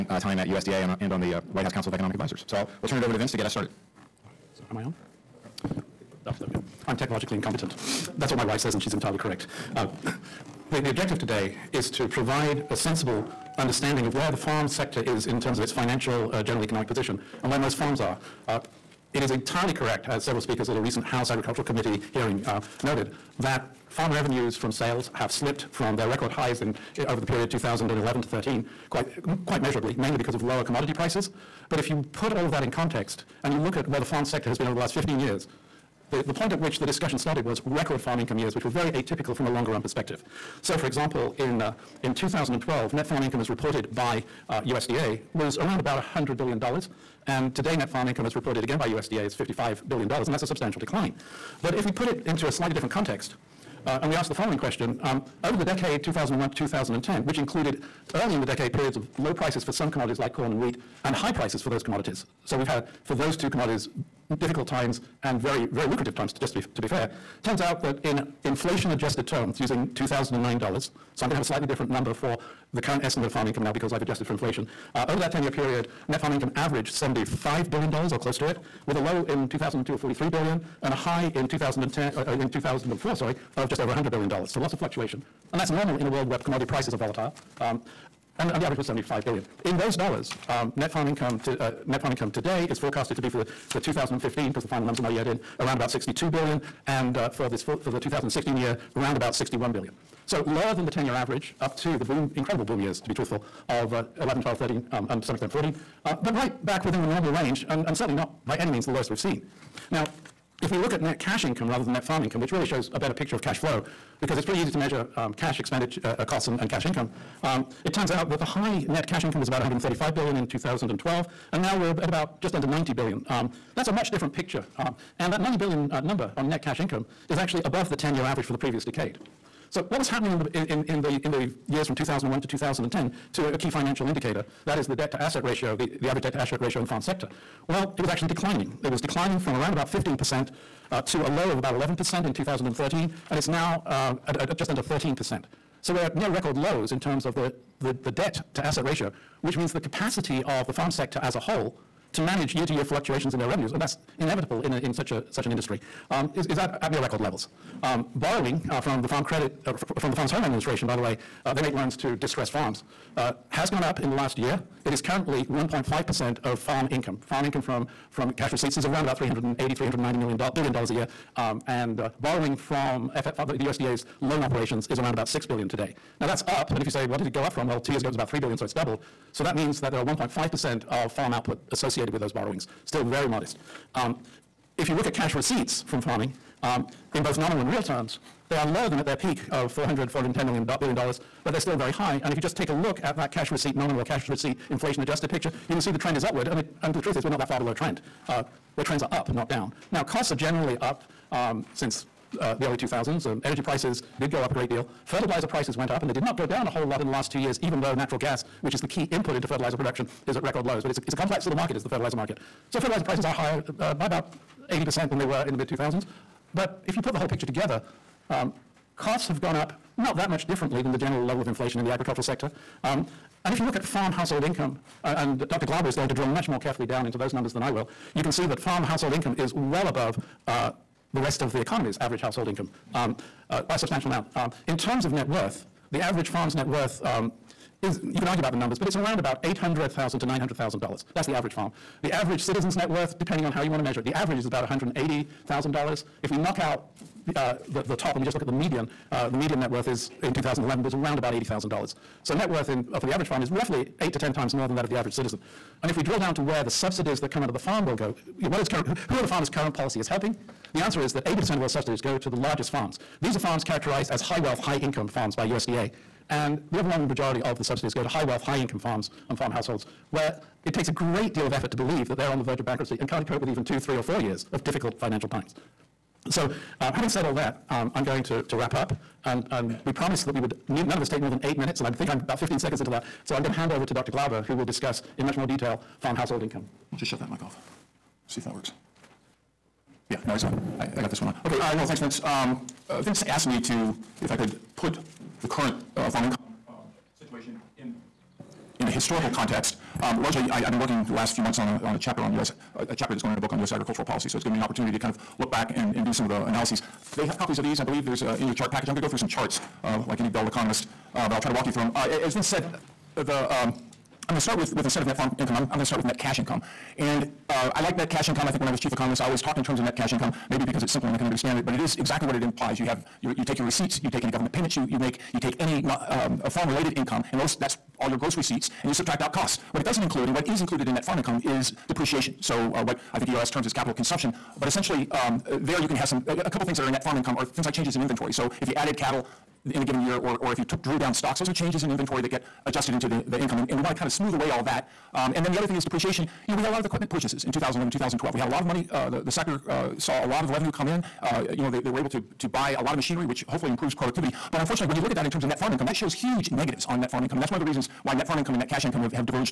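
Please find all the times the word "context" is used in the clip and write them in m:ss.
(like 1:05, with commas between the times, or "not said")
0:32, 0:52, 4:59.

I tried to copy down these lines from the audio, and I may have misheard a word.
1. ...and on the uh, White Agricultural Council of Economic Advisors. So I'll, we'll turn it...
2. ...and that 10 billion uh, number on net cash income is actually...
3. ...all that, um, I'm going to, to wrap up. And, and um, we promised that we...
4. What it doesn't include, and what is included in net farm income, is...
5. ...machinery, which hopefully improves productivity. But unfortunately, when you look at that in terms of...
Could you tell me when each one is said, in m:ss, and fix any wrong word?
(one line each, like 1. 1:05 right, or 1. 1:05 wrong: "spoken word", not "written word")
1. 0:01 wrong: "House", not "Agricultural"
2. 2:05 wrong: "90", not "10"
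3. 4:37 right
4. 5:29 right
5. 5:52 right.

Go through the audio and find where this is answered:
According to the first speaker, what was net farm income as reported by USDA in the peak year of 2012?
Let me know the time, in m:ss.
0:45.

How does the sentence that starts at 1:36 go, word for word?
And uh, for, this, for, for the 2016 year, around about 61 billion.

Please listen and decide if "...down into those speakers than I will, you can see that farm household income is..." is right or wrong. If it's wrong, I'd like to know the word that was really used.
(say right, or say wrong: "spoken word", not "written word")
wrong: "numbers", not "speakers".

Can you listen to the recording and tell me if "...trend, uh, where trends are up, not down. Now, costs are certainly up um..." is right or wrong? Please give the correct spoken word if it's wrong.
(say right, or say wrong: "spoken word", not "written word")
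wrong: "generally", not "certainly".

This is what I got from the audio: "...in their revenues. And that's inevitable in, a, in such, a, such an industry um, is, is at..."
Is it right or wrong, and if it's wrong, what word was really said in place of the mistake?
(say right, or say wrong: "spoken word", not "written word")
right.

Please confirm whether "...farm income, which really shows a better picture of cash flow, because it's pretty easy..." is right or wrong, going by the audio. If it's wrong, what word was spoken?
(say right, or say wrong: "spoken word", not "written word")
right.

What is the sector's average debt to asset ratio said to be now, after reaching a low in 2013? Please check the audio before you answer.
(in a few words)
just under 13%.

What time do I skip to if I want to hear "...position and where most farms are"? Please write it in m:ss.
0:16.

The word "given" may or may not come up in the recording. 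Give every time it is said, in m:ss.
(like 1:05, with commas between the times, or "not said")
5:04, 5:39.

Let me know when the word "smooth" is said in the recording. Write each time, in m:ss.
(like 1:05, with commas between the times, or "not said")
5:44.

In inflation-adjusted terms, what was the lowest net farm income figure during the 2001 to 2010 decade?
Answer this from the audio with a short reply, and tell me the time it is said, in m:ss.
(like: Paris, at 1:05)
43 billion, at 1:19.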